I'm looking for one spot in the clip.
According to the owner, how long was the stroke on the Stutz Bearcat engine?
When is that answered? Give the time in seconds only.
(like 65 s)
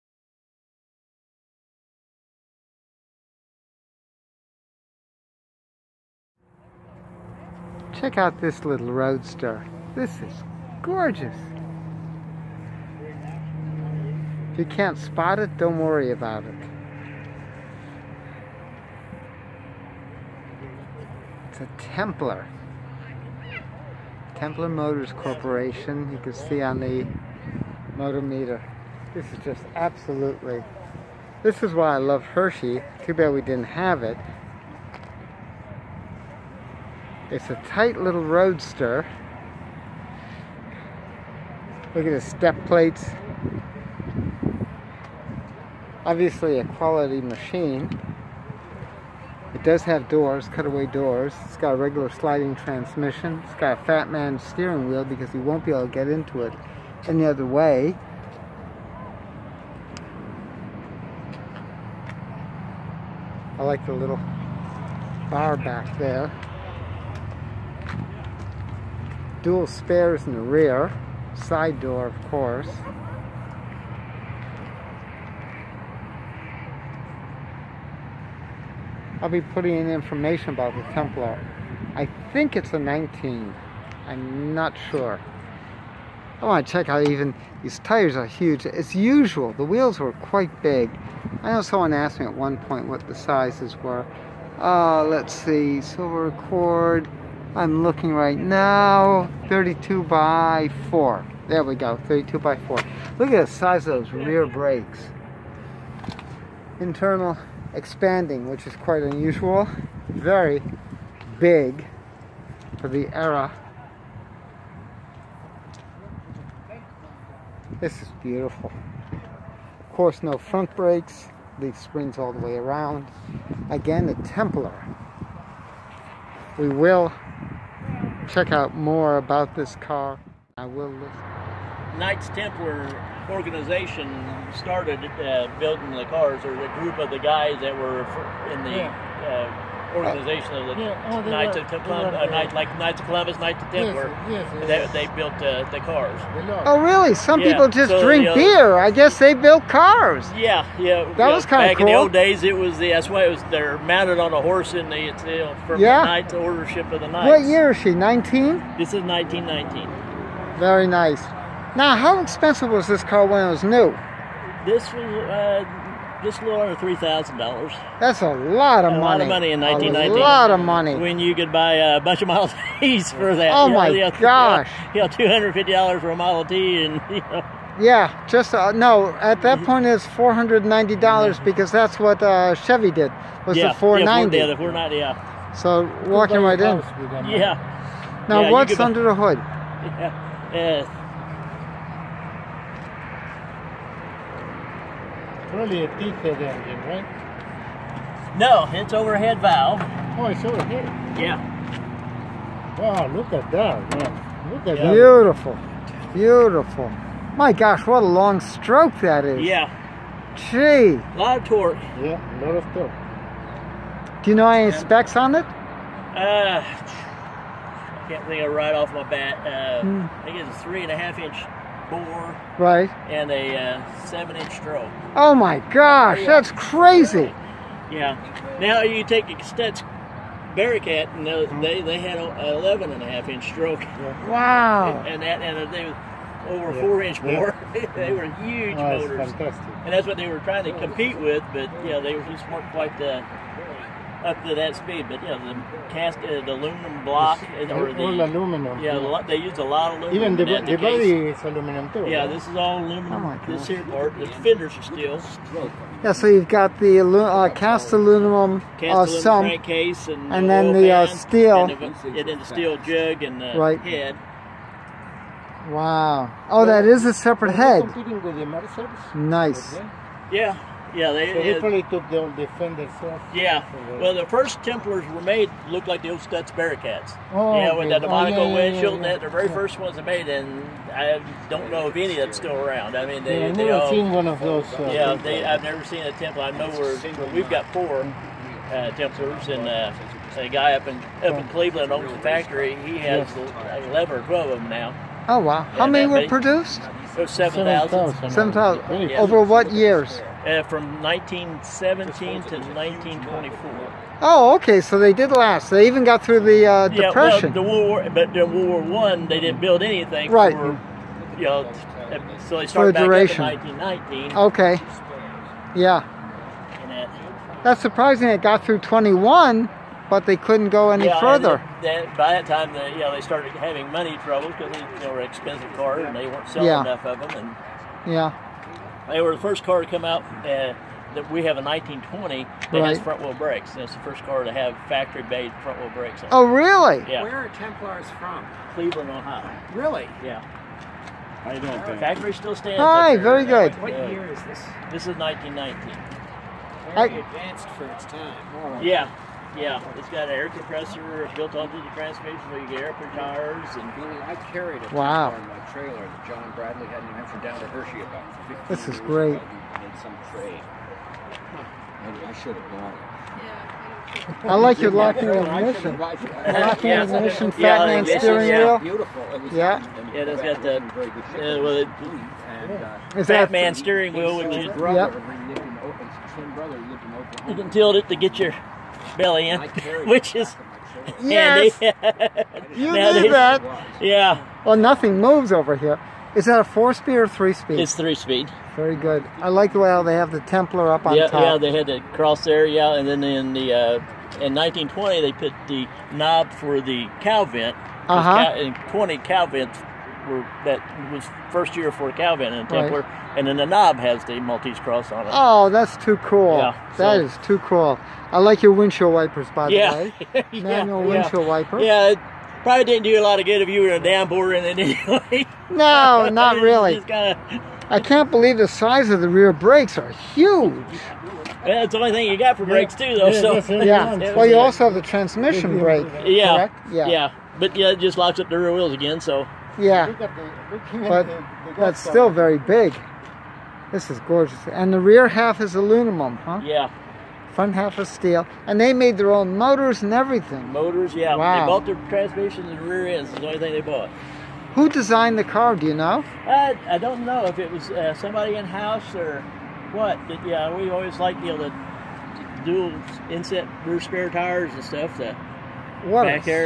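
232 s.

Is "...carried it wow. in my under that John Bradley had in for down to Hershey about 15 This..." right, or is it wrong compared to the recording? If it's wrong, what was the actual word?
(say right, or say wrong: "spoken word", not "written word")
wrong: "trailer", not "under".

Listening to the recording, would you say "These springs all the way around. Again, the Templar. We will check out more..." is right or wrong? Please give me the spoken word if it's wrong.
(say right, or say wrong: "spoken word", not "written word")
right.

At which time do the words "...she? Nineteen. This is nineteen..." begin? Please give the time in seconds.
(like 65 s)
157 s.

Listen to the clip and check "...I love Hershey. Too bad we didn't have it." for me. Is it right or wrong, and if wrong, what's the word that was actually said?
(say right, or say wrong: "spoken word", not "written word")
right.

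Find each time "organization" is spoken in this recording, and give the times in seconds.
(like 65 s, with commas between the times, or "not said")
133 s, 139 s.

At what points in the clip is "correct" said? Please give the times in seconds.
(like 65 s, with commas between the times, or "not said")
426 s.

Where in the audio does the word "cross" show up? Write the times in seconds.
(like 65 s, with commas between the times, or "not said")
392 s, 404 s.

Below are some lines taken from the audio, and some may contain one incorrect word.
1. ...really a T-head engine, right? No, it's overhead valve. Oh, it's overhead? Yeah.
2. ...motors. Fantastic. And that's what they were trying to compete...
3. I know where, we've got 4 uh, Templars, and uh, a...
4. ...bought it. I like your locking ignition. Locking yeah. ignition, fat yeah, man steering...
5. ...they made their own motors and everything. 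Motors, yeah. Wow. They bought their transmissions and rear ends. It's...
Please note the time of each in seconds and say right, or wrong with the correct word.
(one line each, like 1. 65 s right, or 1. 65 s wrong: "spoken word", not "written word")
1. 195 s right
2. 238 s right
3. 286 s right
4. 362 s right
5. 438 s right.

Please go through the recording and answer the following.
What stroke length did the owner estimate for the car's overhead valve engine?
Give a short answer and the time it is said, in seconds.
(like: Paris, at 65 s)
7 inches, at 224 s.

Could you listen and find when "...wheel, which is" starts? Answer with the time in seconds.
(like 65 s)
374 s.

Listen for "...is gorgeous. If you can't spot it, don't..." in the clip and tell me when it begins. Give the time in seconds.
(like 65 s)
10 s.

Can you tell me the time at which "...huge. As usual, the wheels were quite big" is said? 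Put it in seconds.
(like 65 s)
88 s.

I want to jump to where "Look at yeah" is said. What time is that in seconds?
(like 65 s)
204 s.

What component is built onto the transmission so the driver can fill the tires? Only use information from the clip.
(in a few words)
air compressor.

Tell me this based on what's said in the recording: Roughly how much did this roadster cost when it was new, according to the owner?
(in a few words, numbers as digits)
a little under $3,000.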